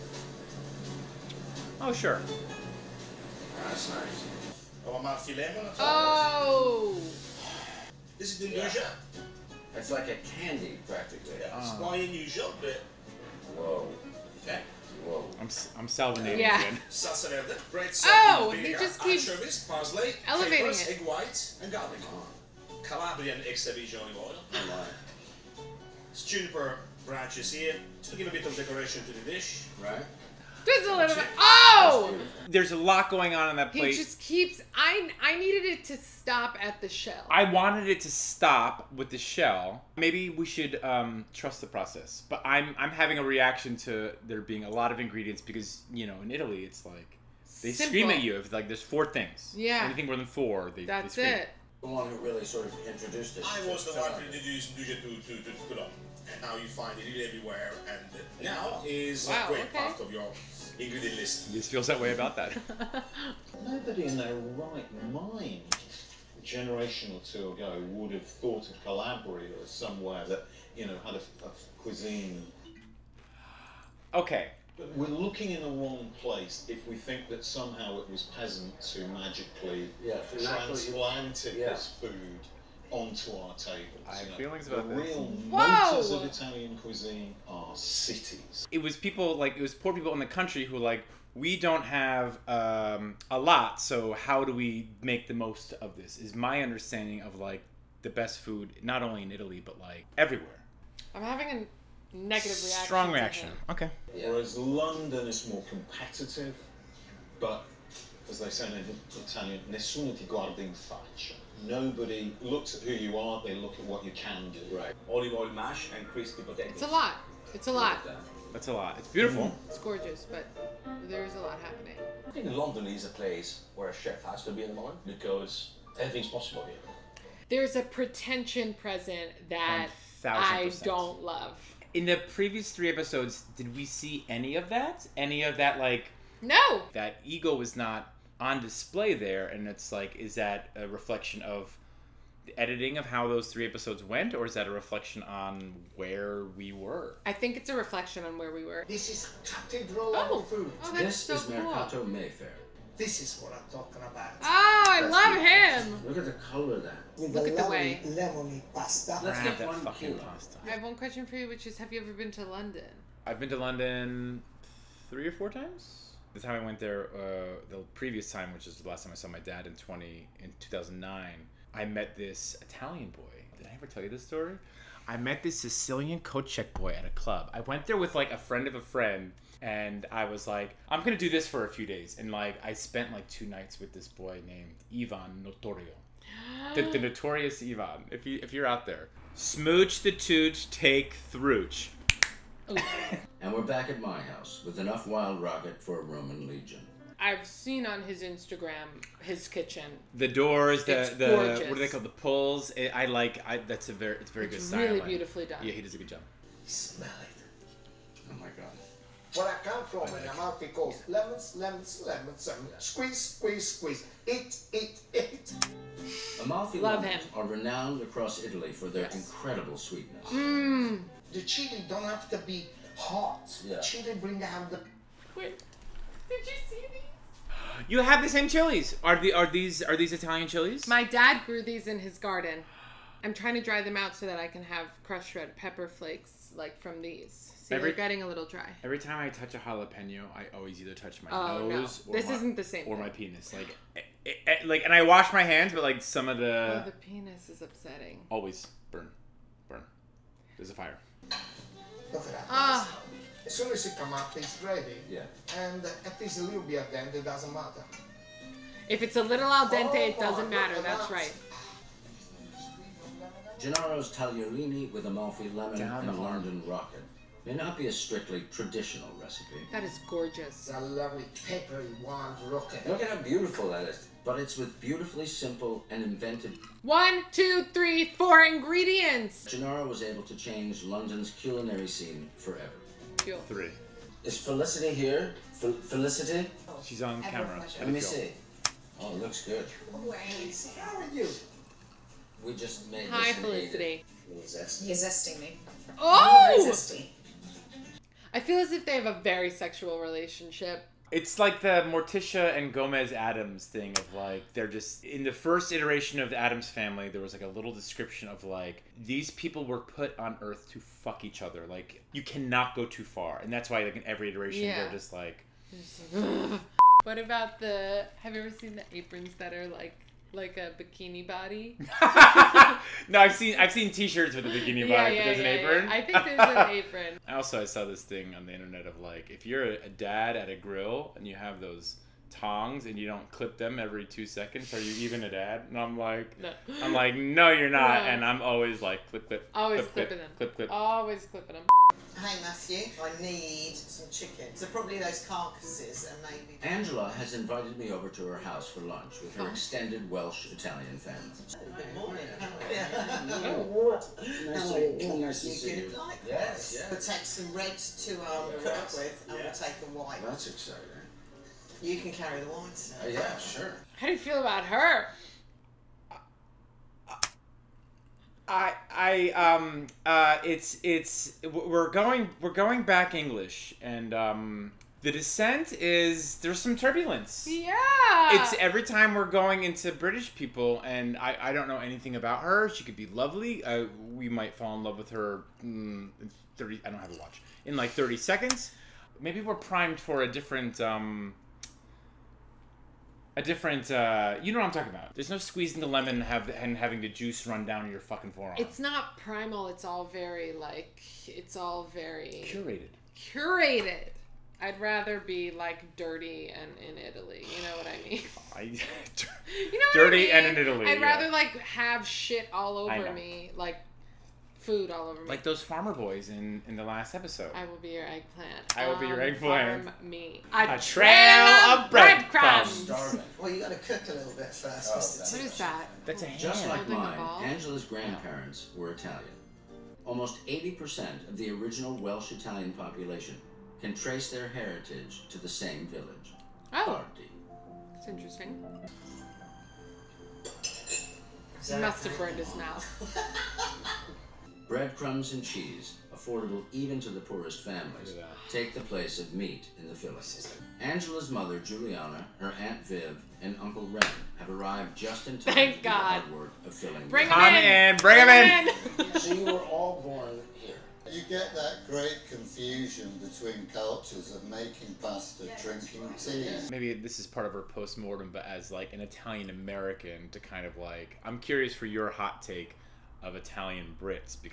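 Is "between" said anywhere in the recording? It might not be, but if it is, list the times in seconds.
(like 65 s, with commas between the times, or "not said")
463 s.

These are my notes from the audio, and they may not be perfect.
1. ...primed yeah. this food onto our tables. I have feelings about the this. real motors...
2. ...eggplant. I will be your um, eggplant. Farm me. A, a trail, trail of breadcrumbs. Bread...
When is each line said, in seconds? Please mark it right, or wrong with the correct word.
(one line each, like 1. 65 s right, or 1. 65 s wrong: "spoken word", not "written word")
1. 80 s wrong: "transplanted", not "primed"
2. 418 s right.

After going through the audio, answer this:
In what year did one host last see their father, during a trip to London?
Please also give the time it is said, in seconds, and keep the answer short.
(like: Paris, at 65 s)
2009, at 170 s.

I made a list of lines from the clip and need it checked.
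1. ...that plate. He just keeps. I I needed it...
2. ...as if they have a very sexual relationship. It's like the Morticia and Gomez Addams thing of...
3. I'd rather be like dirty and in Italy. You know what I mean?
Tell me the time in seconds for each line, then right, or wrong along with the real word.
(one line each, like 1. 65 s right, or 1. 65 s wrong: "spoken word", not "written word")
1. 33 s right
2. 298 s right
3. 404 s right.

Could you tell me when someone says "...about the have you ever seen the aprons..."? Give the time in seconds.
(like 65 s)
317 s.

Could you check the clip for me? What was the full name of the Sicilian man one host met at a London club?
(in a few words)
Ivan Notorio.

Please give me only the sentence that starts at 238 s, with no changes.
Every time I touch a jalapeno, I always either touch my oh, nose.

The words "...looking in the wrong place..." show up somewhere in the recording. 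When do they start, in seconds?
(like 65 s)
75 s.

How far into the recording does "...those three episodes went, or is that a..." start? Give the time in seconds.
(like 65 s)
143 s.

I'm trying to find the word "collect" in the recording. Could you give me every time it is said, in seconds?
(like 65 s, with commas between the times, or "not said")
not said.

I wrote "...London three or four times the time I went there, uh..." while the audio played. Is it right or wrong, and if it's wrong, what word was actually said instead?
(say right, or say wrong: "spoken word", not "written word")
right.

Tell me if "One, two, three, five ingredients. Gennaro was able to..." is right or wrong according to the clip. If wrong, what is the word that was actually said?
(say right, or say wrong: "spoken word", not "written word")
wrong: "four", not "five".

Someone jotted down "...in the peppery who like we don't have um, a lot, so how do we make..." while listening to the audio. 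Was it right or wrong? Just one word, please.
wrong.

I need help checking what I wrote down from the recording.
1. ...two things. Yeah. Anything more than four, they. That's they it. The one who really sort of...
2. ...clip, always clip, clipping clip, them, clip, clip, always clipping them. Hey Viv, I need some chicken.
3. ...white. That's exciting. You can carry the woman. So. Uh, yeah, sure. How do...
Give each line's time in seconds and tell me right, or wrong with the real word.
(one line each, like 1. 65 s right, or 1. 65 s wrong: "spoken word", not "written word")
1. 48 s wrong: "four", not "two"
2. 339 s wrong: "Matthew", not "Viv"
3. 359 s right.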